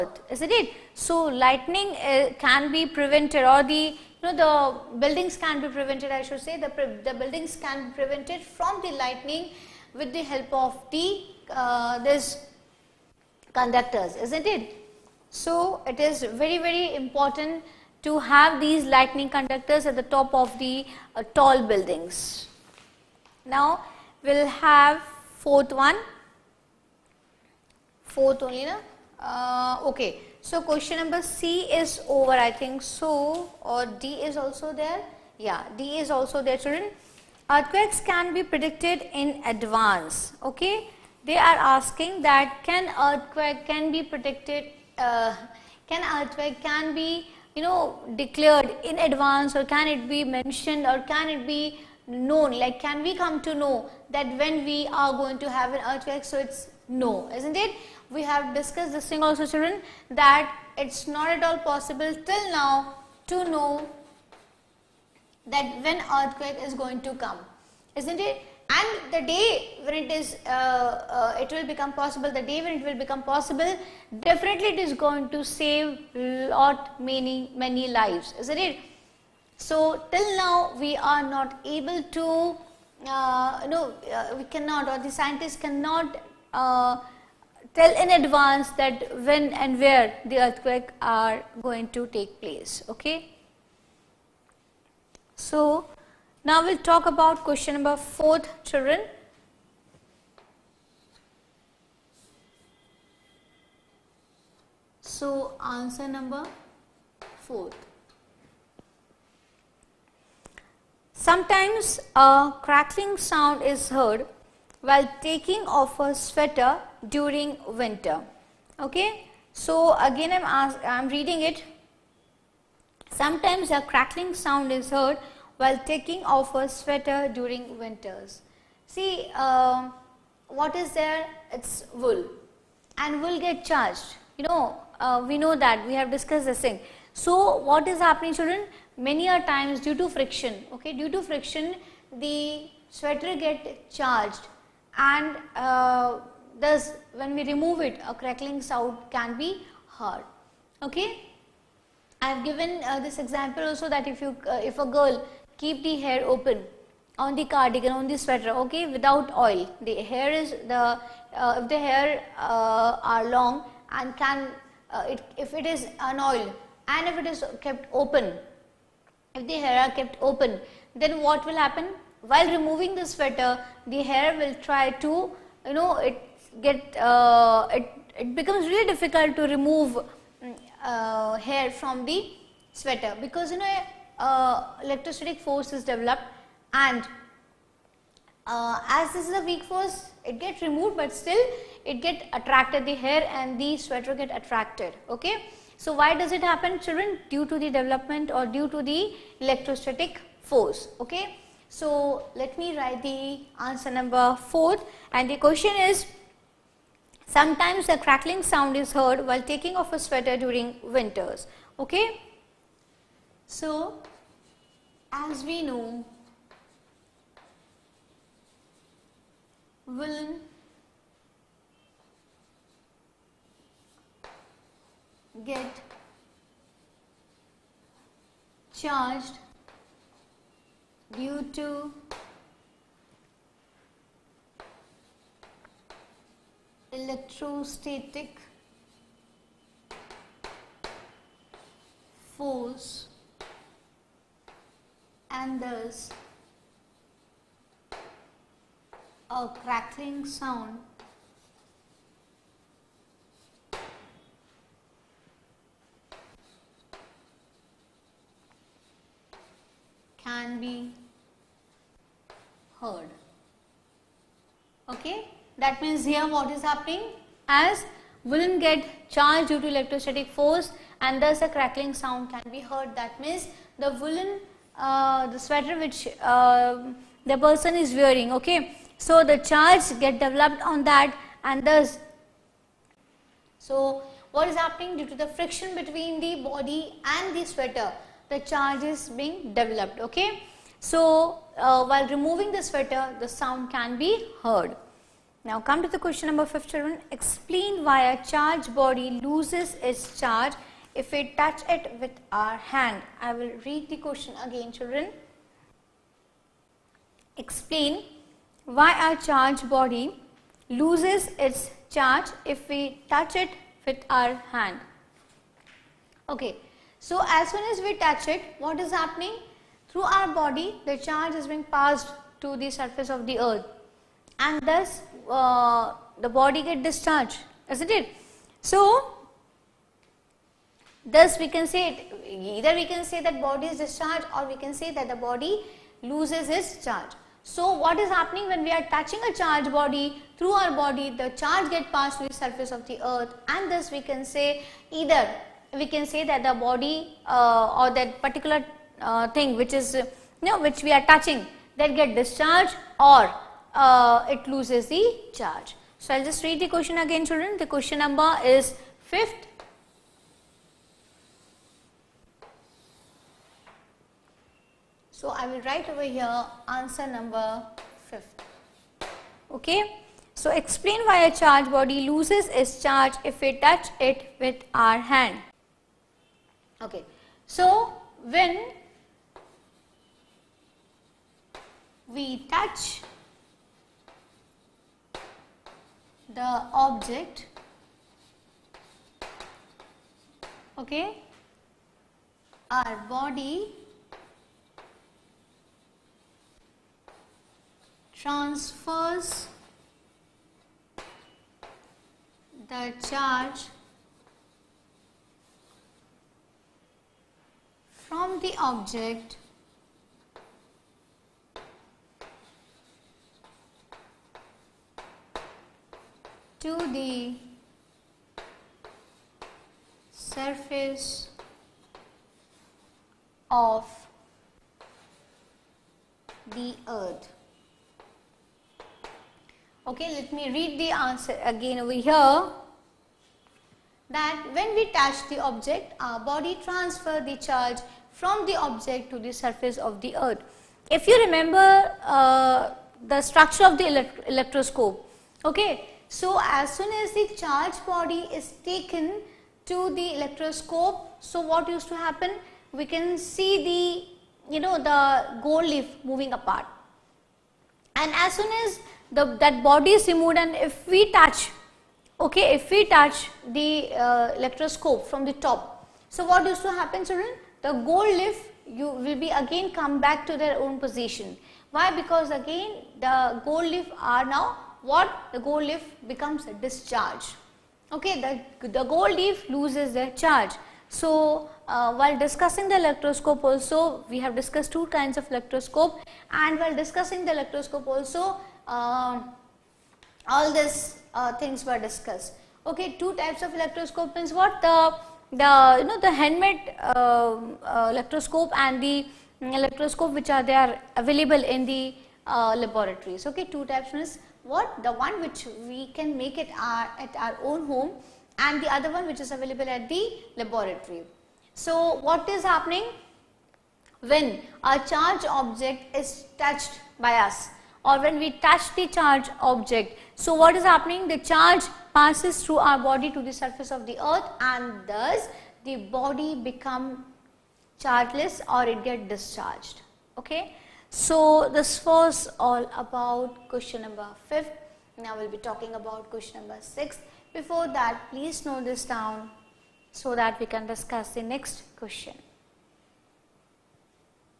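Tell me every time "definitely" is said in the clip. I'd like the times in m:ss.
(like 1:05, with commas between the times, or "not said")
1:14.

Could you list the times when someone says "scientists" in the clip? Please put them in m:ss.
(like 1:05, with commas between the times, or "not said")
1:25.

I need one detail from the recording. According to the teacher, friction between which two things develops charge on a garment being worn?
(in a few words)
the body and the sweater.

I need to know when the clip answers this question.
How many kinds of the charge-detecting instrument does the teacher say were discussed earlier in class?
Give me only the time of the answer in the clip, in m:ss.
8:04.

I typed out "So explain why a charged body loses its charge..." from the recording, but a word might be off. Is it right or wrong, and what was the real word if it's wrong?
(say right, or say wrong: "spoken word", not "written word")
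right.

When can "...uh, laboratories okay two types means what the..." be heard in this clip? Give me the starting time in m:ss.
8:22.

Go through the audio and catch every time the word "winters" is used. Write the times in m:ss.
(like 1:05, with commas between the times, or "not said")
1:57, 2:07, 3:30.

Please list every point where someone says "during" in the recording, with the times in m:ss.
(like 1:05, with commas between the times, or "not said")
1:57, 2:07, 3:30.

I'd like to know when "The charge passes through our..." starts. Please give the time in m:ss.
8:41.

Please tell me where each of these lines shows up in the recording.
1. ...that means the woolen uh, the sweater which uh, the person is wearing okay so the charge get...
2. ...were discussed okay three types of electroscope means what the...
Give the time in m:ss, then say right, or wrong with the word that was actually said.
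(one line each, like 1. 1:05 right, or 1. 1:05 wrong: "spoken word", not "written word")
1. 4:32 right
2. 8:11 wrong: "two", not "three".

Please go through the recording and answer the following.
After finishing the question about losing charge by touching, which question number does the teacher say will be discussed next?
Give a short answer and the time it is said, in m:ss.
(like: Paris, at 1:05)
6, at 8:56.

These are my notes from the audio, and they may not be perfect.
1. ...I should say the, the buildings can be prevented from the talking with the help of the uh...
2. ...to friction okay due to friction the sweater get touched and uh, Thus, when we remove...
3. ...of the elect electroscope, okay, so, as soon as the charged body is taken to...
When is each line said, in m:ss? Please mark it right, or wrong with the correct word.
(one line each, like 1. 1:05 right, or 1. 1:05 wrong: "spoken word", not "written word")
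1. 0:06 wrong: "lightning", not "talking"
2. 2:19 wrong: "charged", not "touched"
3. 7:23 right.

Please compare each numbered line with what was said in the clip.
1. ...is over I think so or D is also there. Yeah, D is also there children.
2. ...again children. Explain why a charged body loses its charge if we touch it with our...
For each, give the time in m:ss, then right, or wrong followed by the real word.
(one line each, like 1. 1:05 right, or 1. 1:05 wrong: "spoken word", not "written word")
1. 0:31 right
2. 5:04 right.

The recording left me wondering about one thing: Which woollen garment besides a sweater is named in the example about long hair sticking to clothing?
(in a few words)
cardigan.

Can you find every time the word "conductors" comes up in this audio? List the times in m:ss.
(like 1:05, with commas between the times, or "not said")
0:13, 0:19.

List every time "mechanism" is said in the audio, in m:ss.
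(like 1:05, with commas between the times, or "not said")
not said.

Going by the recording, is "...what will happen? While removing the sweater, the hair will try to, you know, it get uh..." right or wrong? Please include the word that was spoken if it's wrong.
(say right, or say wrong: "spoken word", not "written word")
right.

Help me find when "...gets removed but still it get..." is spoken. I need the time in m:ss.
3:10.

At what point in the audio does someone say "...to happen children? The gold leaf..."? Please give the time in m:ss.
7:46.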